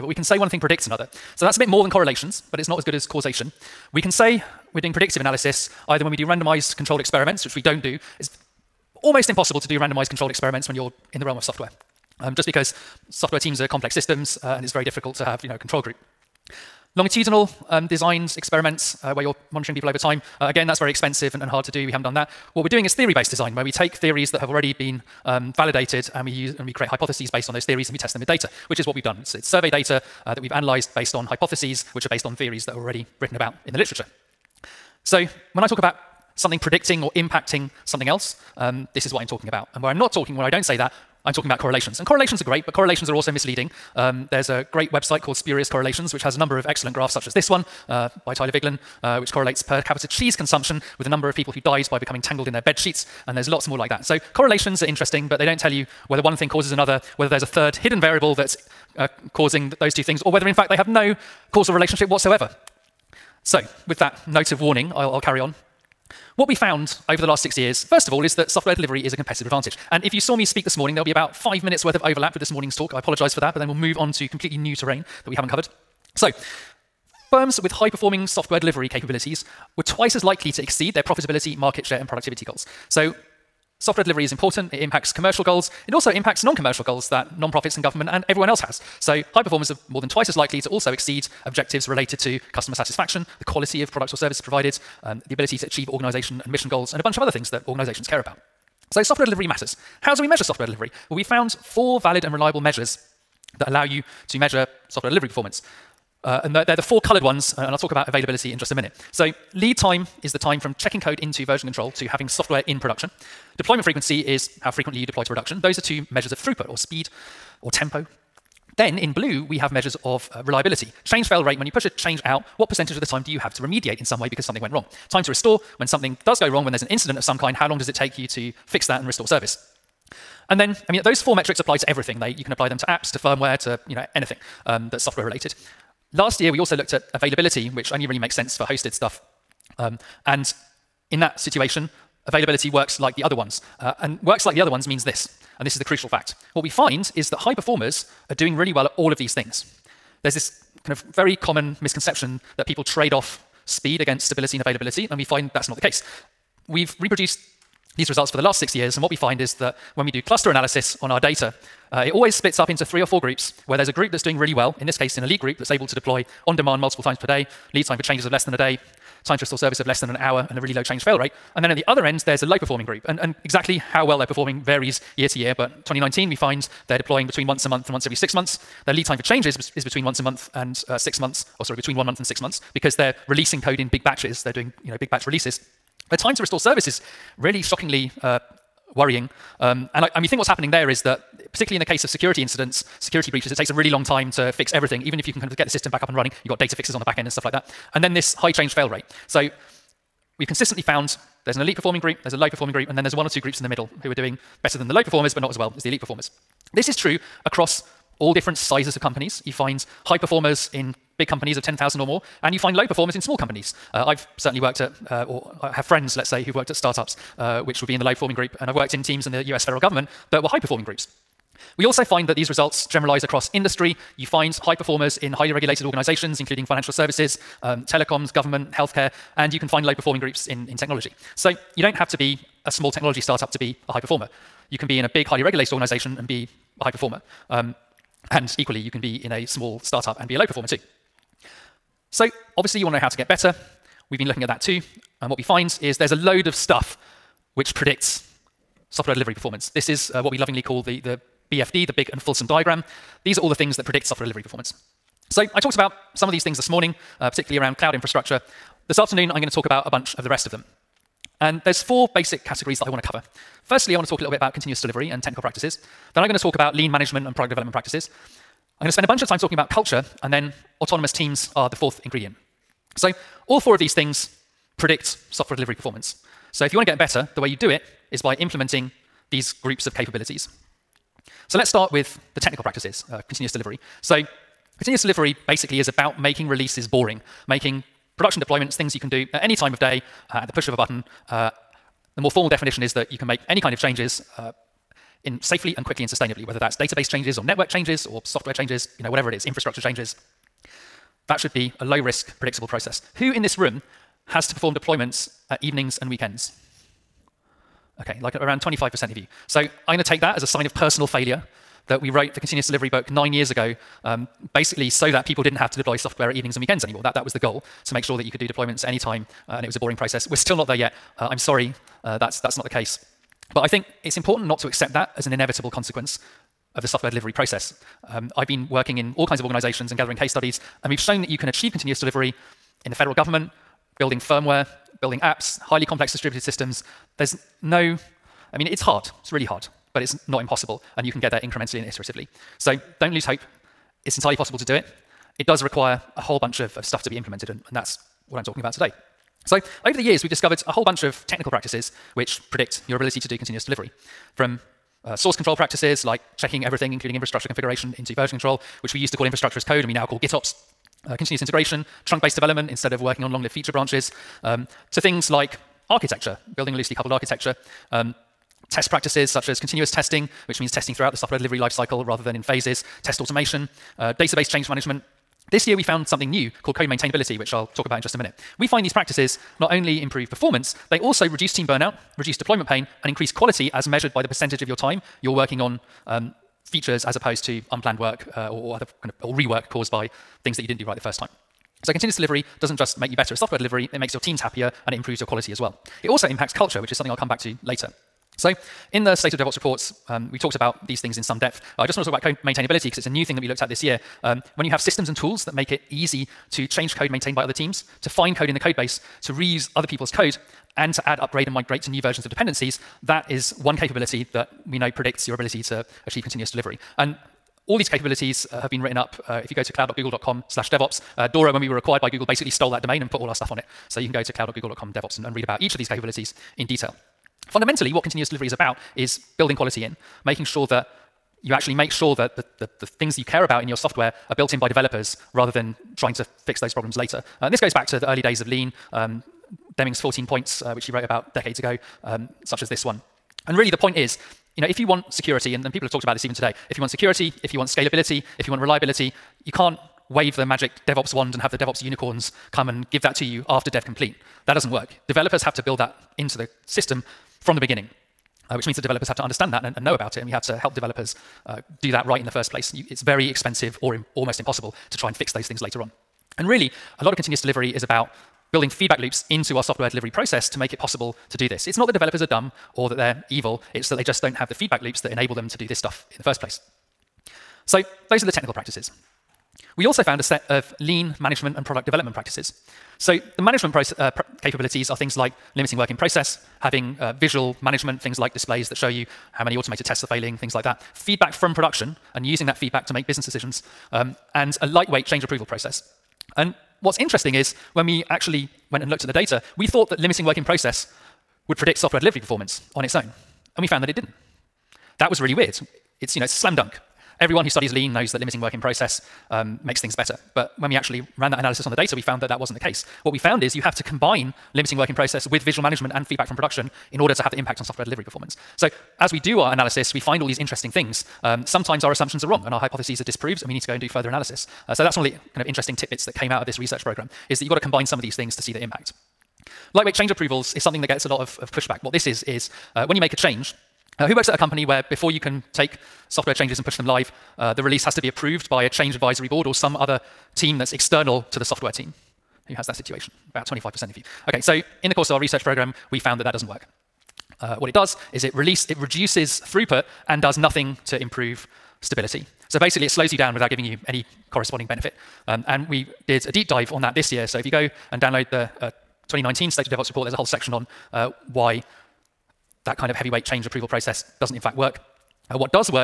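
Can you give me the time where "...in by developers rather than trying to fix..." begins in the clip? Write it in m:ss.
7:14.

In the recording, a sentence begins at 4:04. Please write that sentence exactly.
We've been looking at that too.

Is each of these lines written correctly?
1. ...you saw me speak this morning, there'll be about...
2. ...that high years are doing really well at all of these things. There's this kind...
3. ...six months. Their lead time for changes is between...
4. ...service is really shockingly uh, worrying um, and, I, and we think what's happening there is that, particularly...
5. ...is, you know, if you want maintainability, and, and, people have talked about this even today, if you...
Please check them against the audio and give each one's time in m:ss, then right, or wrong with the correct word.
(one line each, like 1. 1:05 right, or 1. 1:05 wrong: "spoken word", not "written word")
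1. 1:10 right
2. 2:27 wrong: "performers", not "years"
3. 2:58 right
4. 3:06 right
5. 7:23 wrong: "security", not "maintainability".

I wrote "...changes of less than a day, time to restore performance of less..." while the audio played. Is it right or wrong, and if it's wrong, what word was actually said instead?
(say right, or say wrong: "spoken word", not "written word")
wrong: "service", not "performance".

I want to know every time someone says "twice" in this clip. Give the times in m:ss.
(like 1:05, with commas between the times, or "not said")
1:19, 1:30.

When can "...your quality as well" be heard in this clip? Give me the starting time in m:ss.
6:35.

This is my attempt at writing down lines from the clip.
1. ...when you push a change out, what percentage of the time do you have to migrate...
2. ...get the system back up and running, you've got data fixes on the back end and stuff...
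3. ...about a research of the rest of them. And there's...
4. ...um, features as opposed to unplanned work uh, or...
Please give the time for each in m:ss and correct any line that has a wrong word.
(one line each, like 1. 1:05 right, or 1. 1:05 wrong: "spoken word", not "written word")
1. 2:01 wrong: "remediate", not "migrate"
2. 3:15 right
3. 4:19 wrong: "bunch", not "research"
4. 6:26 right.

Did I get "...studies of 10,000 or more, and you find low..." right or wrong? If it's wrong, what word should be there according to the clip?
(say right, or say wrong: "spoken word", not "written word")
wrong: "companies", not "studies".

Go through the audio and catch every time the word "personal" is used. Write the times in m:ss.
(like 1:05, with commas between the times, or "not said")
5:10.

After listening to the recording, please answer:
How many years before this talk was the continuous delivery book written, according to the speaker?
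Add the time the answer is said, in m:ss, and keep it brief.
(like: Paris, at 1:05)
9, at 5:13.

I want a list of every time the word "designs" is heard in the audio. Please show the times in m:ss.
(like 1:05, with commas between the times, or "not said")
0:17, 0:23.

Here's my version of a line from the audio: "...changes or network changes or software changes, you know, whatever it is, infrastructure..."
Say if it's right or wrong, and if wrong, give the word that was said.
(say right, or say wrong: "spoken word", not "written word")
right.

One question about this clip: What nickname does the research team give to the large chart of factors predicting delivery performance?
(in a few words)
The big and fulsome diagram.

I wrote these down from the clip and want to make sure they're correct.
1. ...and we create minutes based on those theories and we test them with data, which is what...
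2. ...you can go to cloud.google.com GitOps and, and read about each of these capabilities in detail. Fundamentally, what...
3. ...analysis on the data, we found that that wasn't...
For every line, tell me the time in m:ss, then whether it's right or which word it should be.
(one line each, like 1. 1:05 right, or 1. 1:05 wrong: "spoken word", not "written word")
1. 0:26 wrong: "hypotheses", not "minutes"
2. 7:03 wrong: "DevOps", not "GitOps"
3. 8:31 right.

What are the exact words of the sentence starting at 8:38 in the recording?
So as we do our analysis, we find all these interesting things.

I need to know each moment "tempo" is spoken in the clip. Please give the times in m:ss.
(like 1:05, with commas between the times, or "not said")
1:57.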